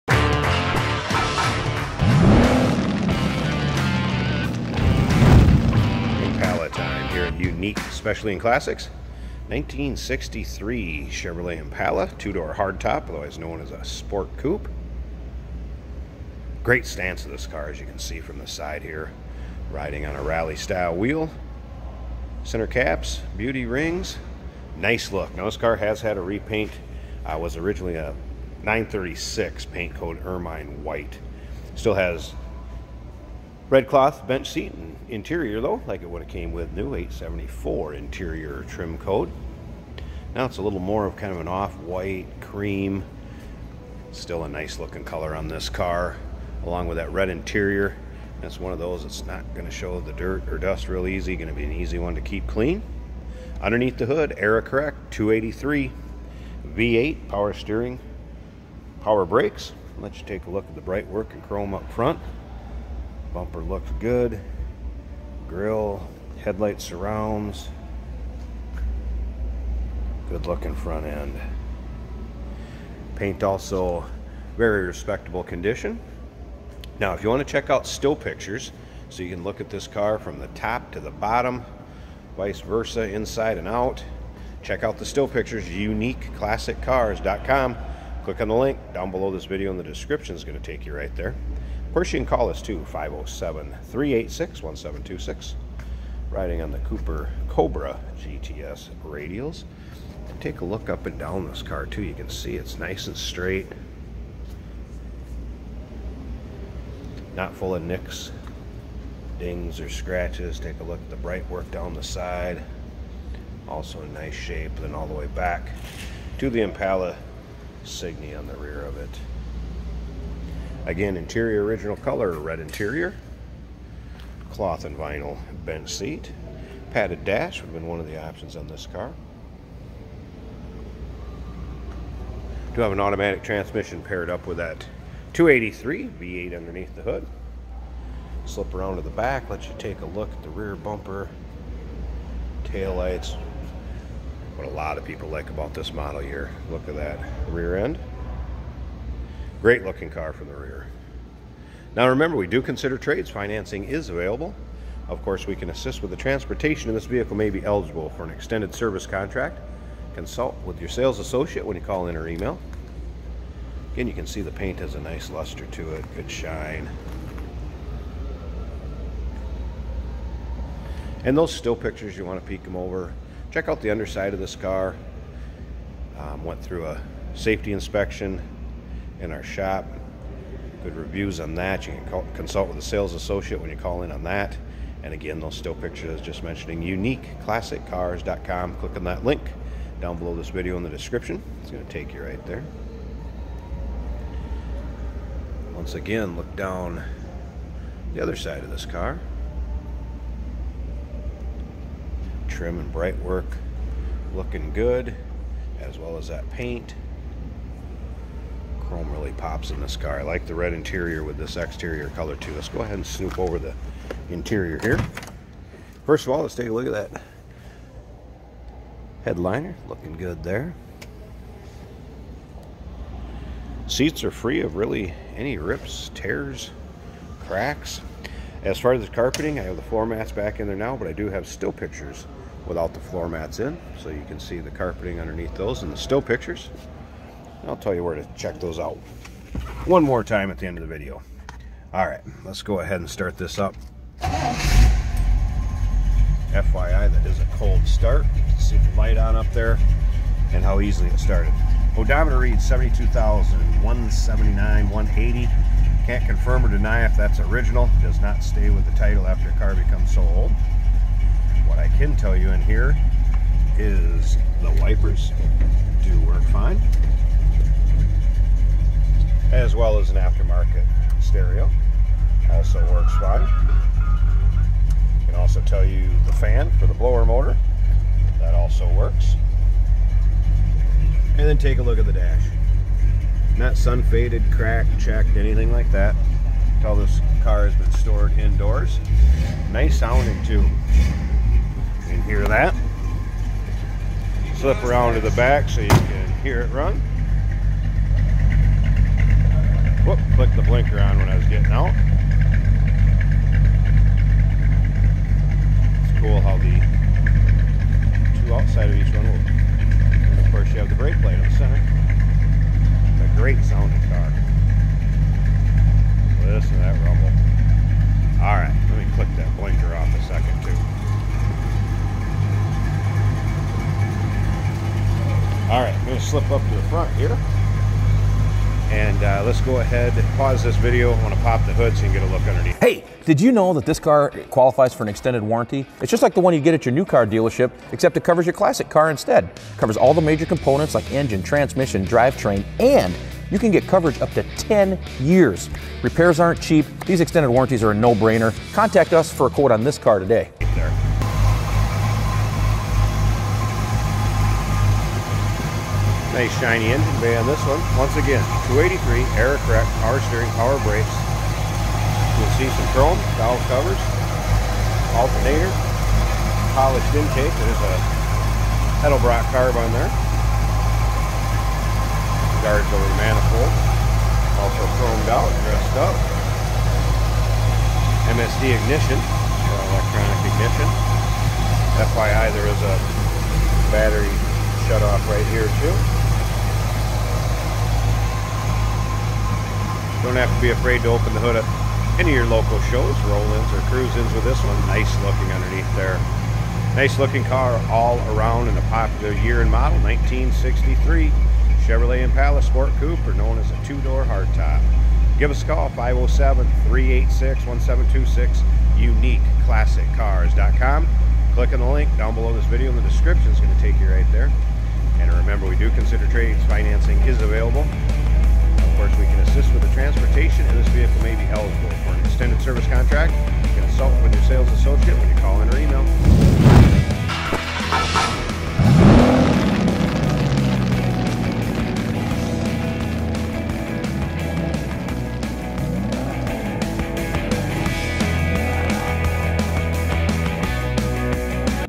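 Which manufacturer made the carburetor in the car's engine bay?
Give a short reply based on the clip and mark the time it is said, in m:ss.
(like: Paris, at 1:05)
Edelbrock, at 6:09.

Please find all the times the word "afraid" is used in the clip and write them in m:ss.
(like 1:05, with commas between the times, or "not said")
6:30.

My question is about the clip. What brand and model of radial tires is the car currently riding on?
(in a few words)
Cooper Cobra GTS.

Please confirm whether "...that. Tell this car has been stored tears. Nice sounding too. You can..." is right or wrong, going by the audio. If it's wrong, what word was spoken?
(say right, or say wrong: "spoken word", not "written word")
wrong: "indoors", not "tears".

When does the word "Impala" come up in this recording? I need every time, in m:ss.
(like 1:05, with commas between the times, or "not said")
0:11, 1:56, 6:42.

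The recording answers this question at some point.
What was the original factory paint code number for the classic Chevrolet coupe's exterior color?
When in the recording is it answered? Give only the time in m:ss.
0:28.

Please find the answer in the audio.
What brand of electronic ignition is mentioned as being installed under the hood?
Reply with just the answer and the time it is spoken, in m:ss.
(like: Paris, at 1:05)
MSD, at 6:18.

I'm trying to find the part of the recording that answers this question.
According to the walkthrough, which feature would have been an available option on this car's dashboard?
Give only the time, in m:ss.
2:06.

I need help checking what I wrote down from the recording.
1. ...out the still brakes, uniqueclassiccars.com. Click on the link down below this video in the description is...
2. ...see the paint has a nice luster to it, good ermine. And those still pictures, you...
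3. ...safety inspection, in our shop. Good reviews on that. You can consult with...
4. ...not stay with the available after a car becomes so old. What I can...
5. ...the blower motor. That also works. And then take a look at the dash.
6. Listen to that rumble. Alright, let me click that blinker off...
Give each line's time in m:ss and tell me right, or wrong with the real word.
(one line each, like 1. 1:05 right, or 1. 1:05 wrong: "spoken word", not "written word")
1. 1:24 wrong: "pictures", not "brakes"
2. 2:44 wrong: "shine", not "ermine"
3. 2:57 right
4. 4:18 wrong: "title", not "available"
5. 4:36 right
6. 5:16 right.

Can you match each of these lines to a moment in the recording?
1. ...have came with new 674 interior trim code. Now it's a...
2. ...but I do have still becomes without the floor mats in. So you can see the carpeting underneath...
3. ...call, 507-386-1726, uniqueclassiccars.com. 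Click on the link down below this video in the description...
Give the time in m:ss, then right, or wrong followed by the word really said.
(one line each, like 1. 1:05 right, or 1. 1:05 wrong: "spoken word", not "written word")
1. 0:36 wrong: "874", not "674"
2. 3:50 wrong: "pictures", not "becomes"
3. 6:45 right.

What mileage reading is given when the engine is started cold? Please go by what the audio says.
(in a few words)
72,179.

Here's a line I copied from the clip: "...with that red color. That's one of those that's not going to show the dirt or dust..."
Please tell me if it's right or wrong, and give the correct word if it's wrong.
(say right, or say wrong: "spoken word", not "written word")
wrong: "interior", not "color".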